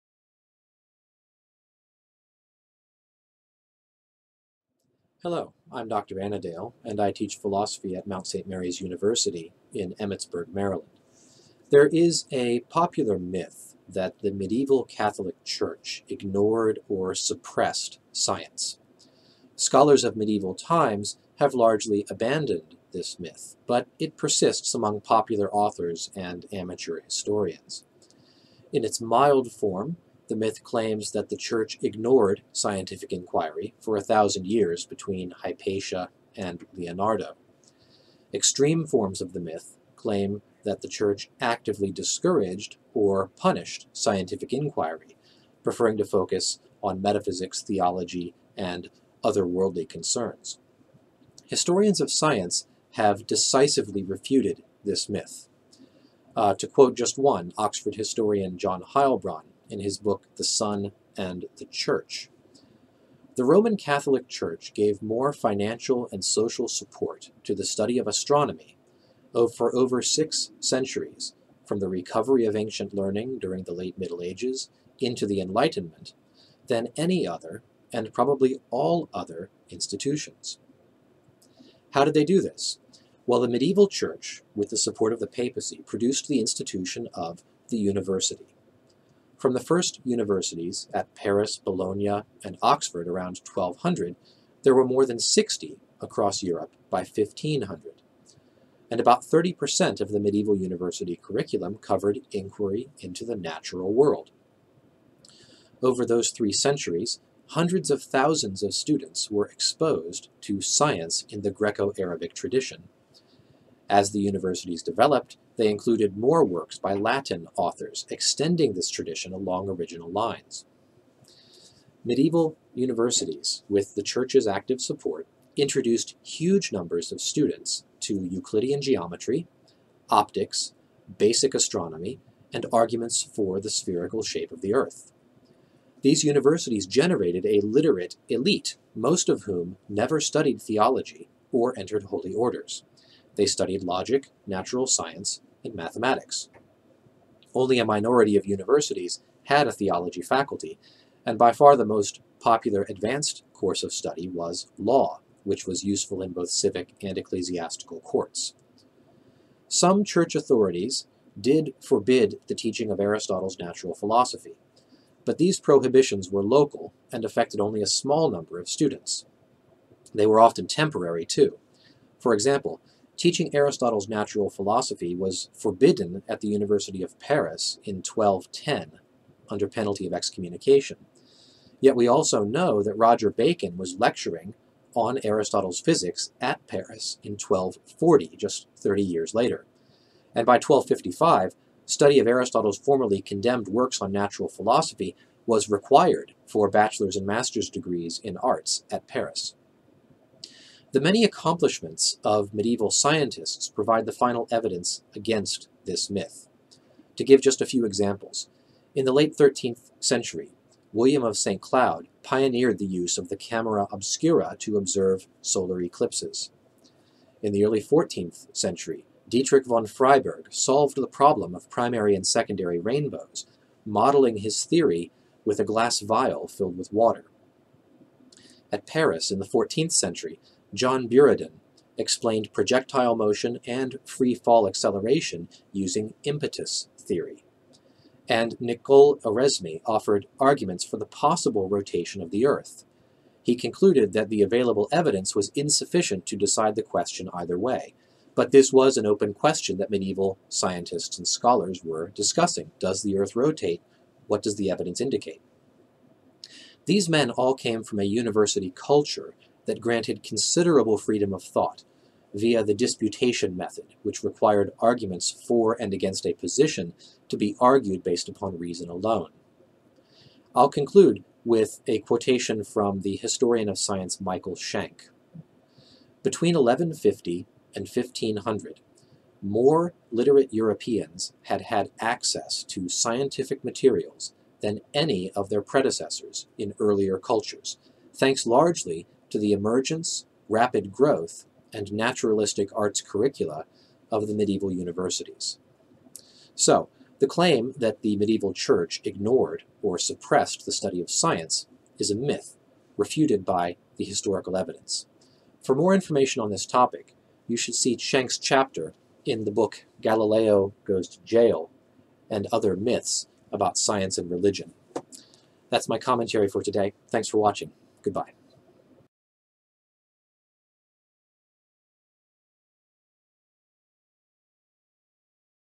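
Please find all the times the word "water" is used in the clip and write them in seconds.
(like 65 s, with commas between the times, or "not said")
226 s.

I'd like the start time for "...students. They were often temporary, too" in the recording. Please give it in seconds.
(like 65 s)
168 s.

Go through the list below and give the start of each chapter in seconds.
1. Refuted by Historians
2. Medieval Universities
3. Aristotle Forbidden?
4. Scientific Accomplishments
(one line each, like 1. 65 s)
1. 51 s
2. 81 s
3. 159 s
4. 200 s.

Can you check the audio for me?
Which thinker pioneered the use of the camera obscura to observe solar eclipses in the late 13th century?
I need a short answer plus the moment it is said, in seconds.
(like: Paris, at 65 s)
William of St. Cloud, at 210 s.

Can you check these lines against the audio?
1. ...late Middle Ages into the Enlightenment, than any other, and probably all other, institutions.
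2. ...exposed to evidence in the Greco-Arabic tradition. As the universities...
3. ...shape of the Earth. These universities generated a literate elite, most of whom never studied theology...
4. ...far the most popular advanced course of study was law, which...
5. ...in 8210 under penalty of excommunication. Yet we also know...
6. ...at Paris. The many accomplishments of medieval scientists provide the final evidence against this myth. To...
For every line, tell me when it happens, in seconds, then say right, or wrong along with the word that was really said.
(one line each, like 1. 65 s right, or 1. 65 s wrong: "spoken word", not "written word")
1. 73 s right
2. 109 s wrong: "science", not "evidence"
3. 134 s right
4. 151 s right
5. 177 s wrong: "1210", not "8210"
6. 198 s right.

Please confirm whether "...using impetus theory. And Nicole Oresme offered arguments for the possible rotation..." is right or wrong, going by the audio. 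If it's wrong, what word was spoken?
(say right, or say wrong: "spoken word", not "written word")
right.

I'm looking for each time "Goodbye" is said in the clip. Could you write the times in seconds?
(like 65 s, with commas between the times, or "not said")
318 s.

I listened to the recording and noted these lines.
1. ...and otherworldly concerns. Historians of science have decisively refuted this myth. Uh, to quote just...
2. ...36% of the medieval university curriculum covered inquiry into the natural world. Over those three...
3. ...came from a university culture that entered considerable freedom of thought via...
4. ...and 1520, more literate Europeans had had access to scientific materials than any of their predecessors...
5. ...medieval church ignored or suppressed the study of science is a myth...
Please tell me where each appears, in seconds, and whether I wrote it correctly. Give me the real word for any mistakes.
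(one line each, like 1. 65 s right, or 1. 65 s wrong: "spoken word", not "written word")
1. 48 s right
2. 99 s wrong: "30", not "36"
3. 257 s wrong: "granted", not "entered"
4. 277 s wrong: "1500", not "1520"
5. 298 s right.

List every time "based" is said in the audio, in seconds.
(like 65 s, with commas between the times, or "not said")
268 s.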